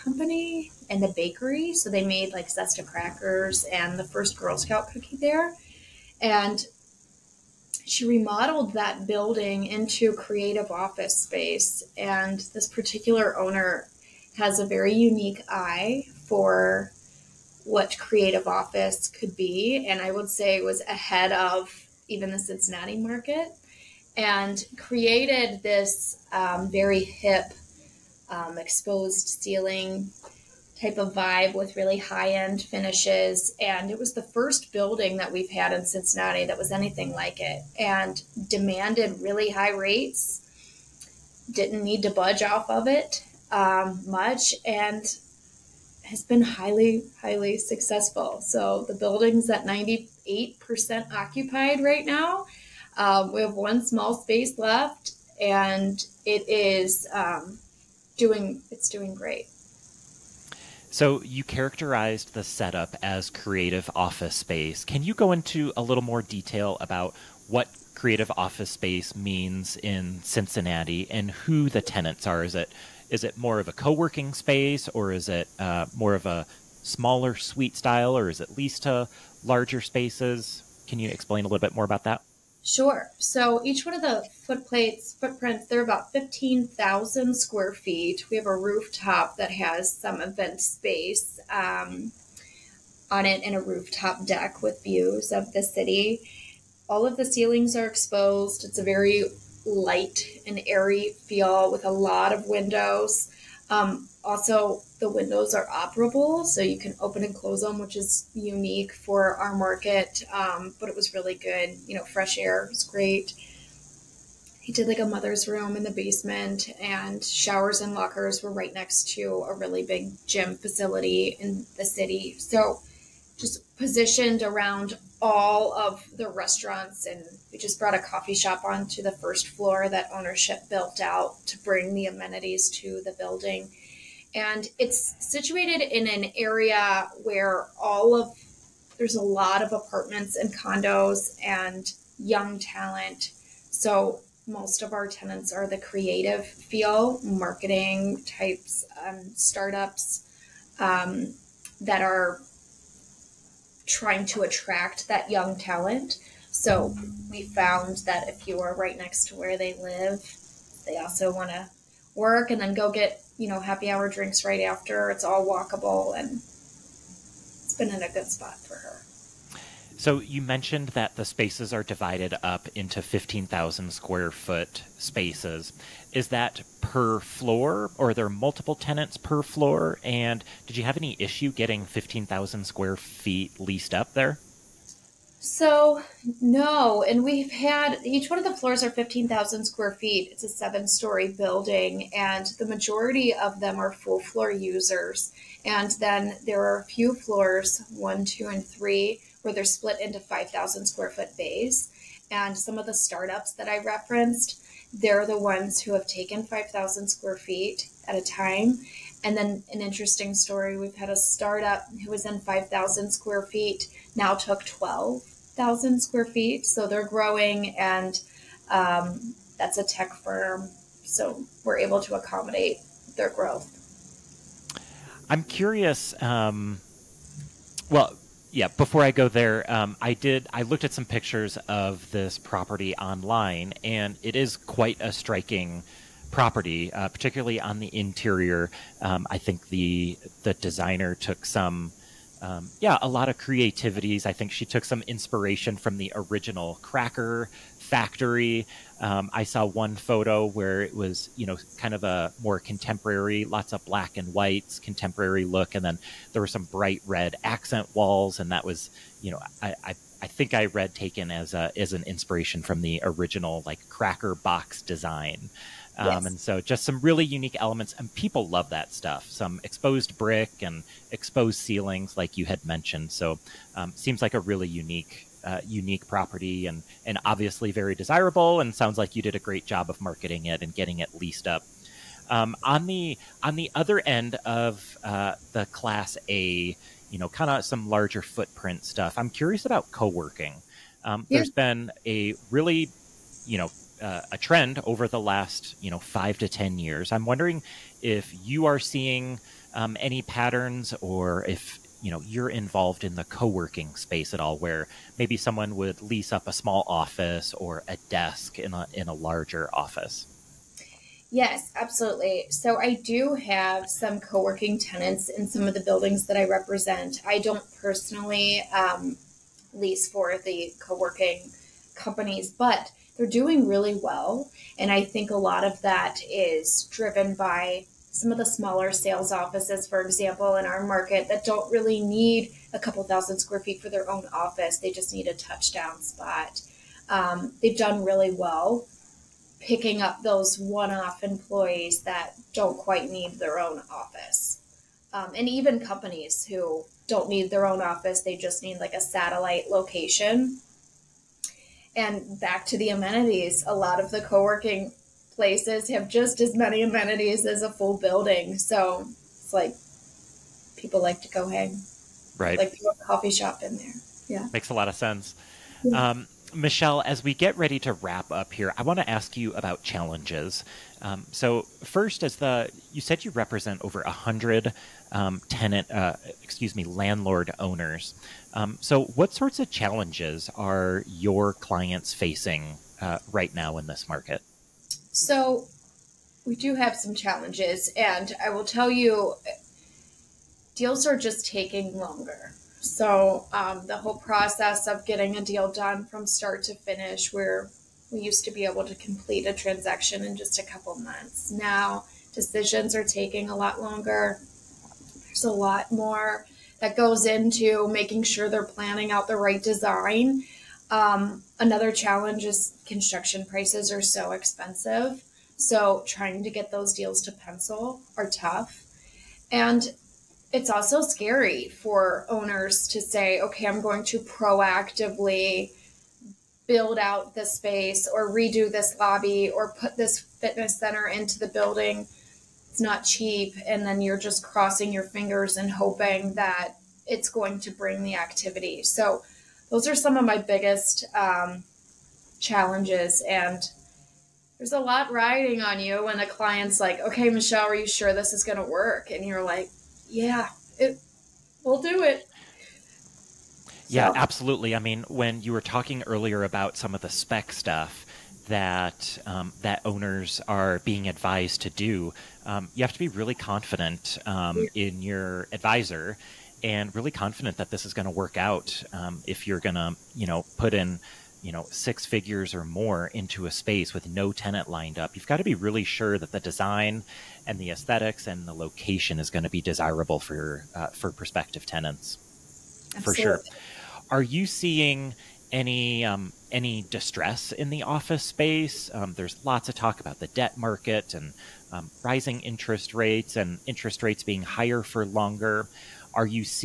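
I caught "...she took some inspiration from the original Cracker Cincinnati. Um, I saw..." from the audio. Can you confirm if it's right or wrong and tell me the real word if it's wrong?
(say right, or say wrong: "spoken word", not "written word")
wrong: "Factory", not "Cincinnati".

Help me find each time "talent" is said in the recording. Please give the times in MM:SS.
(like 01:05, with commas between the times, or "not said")
02:22, 02:35.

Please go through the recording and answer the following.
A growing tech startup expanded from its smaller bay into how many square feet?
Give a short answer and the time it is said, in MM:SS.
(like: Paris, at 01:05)
12000, at 03:34.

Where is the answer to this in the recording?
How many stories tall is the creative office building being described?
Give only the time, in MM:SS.
03:10.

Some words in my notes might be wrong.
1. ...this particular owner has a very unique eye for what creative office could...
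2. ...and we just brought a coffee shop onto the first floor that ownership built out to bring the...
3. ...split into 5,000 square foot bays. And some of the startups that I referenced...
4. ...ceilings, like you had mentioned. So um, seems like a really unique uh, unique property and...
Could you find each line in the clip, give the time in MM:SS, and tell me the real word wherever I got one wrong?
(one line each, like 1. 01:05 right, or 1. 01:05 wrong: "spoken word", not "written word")
1. 00:12 right
2. 02:07 right
3. 03:19 right
4. 04:31 right.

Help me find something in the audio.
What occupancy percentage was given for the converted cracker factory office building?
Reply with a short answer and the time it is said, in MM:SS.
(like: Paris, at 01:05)
98%, at 00:49.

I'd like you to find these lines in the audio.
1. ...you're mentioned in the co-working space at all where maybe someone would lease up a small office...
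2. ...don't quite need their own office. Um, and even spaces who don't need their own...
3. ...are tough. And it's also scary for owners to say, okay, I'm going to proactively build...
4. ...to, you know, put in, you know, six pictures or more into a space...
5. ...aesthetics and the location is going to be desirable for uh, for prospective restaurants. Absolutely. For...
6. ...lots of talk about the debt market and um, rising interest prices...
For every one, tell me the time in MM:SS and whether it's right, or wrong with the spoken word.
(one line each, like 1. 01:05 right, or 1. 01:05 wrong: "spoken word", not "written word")
1. 05:02 wrong: "involved", not "mentioned"
2. 05:42 wrong: "companies", not "spaces"
3. 06:58 right
4. 07:49 wrong: "figures", not "pictures"
5. 07:57 wrong: "tenants", not "restaurants"
6. 08:09 wrong: "rates", not "prices".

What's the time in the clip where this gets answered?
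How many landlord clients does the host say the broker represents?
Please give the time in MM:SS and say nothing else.
06:13.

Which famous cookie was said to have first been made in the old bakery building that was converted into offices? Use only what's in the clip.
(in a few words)
Girl Scout cookie.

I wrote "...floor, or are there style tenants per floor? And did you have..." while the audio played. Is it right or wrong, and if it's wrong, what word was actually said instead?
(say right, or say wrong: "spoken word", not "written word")
wrong: "multiple", not "style".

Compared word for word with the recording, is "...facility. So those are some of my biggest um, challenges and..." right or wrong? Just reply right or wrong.
wrong.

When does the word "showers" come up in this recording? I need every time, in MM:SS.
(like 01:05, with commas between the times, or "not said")
01:57.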